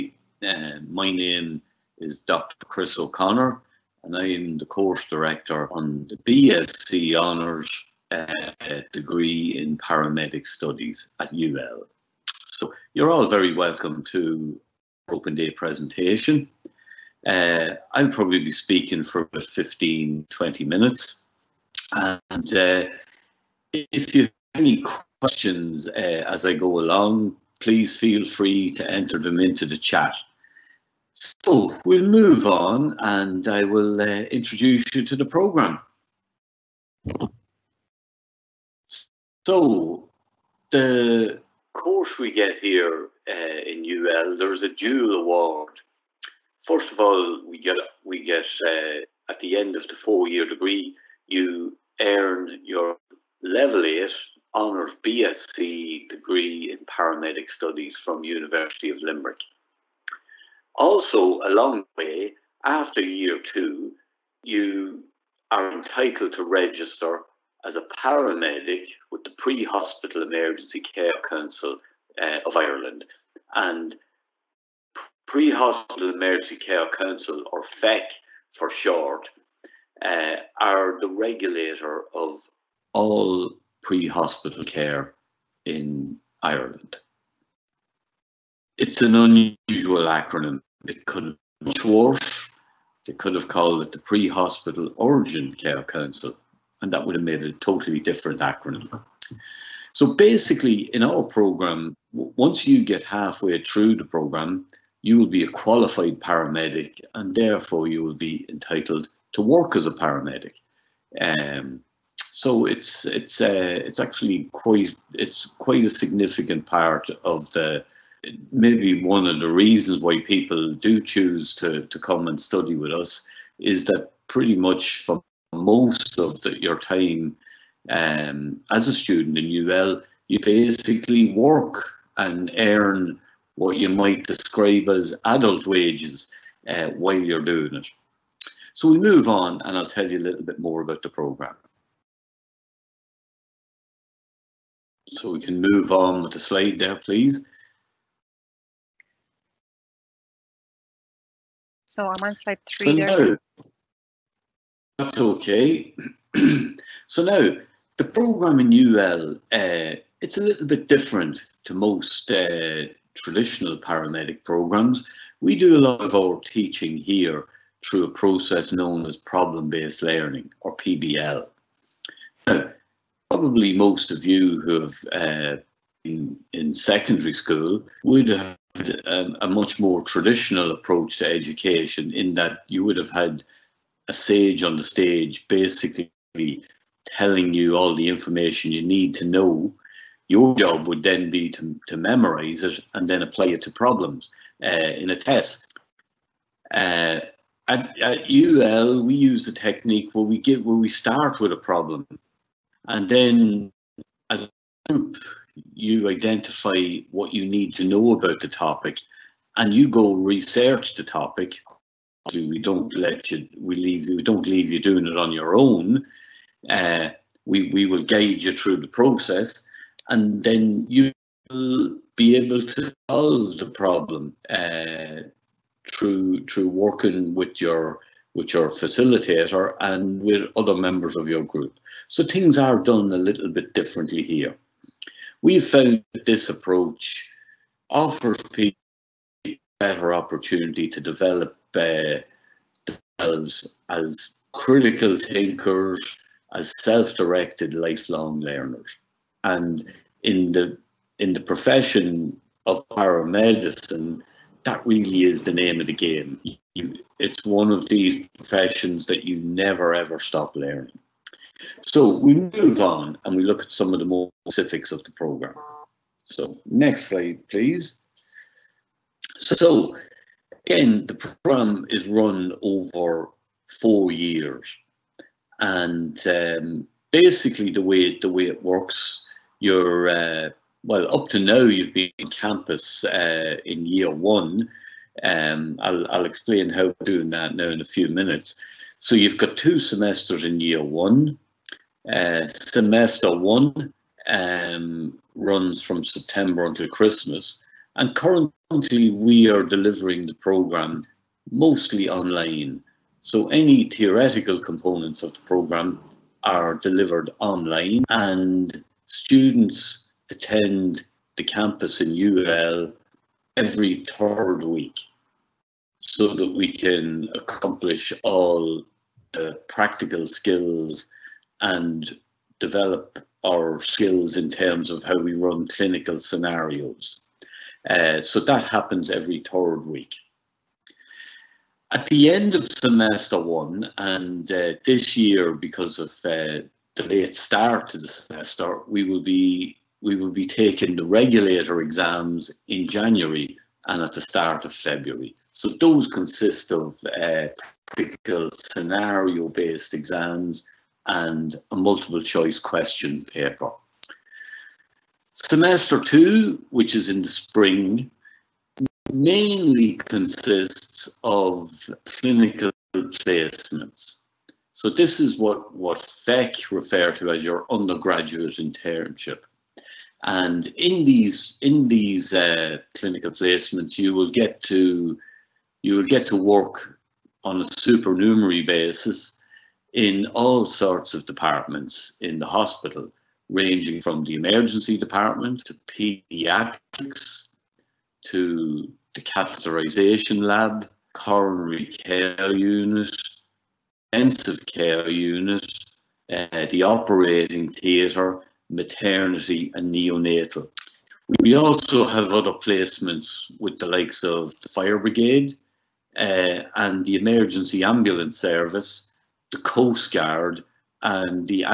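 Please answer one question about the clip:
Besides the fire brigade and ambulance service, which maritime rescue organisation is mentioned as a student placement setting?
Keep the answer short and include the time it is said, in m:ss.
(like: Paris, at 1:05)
The Coast Guard, at 6:49.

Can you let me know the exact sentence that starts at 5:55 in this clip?
Semester two, which is in the spring, mainly consists of clinical placements.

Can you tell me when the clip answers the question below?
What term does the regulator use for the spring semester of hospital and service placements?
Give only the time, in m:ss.
6:07.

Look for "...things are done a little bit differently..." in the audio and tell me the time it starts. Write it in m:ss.
3:52.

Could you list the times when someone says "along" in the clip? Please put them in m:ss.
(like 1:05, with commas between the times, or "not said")
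0:26, 1:01.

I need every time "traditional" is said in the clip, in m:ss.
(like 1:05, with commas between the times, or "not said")
2:43, 3:00.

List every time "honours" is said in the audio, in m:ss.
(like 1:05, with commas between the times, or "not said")
0:07, 0:54.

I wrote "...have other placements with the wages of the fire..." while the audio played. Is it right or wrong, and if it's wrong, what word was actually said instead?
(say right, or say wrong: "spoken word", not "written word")
wrong: "likes", not "wages".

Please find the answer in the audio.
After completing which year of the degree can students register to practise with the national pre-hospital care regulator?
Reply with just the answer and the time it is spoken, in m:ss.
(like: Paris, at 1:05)
Year 2, at 1:03.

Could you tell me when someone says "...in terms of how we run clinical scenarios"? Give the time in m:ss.
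5:24.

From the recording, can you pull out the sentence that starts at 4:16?
You, it's one of these professions that you never ever stop learning.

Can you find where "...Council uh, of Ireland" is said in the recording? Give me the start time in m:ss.
1:11.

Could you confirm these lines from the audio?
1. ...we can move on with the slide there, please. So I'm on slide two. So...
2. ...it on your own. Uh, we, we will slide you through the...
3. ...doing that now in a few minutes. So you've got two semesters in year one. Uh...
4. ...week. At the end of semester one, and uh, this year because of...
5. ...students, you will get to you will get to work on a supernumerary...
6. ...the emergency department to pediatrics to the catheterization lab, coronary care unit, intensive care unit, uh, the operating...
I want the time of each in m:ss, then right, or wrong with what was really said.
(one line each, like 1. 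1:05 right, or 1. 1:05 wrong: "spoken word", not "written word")
1. 2:25 wrong: "three", not "two"
2. 3:35 wrong: "guide", not "slide"
3. 4:47 right
4. 5:29 right
5. 6:13 wrong: "placements", not "students"
6. 6:24 right.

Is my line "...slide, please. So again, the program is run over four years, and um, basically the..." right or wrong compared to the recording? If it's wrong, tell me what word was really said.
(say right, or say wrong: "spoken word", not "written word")
right.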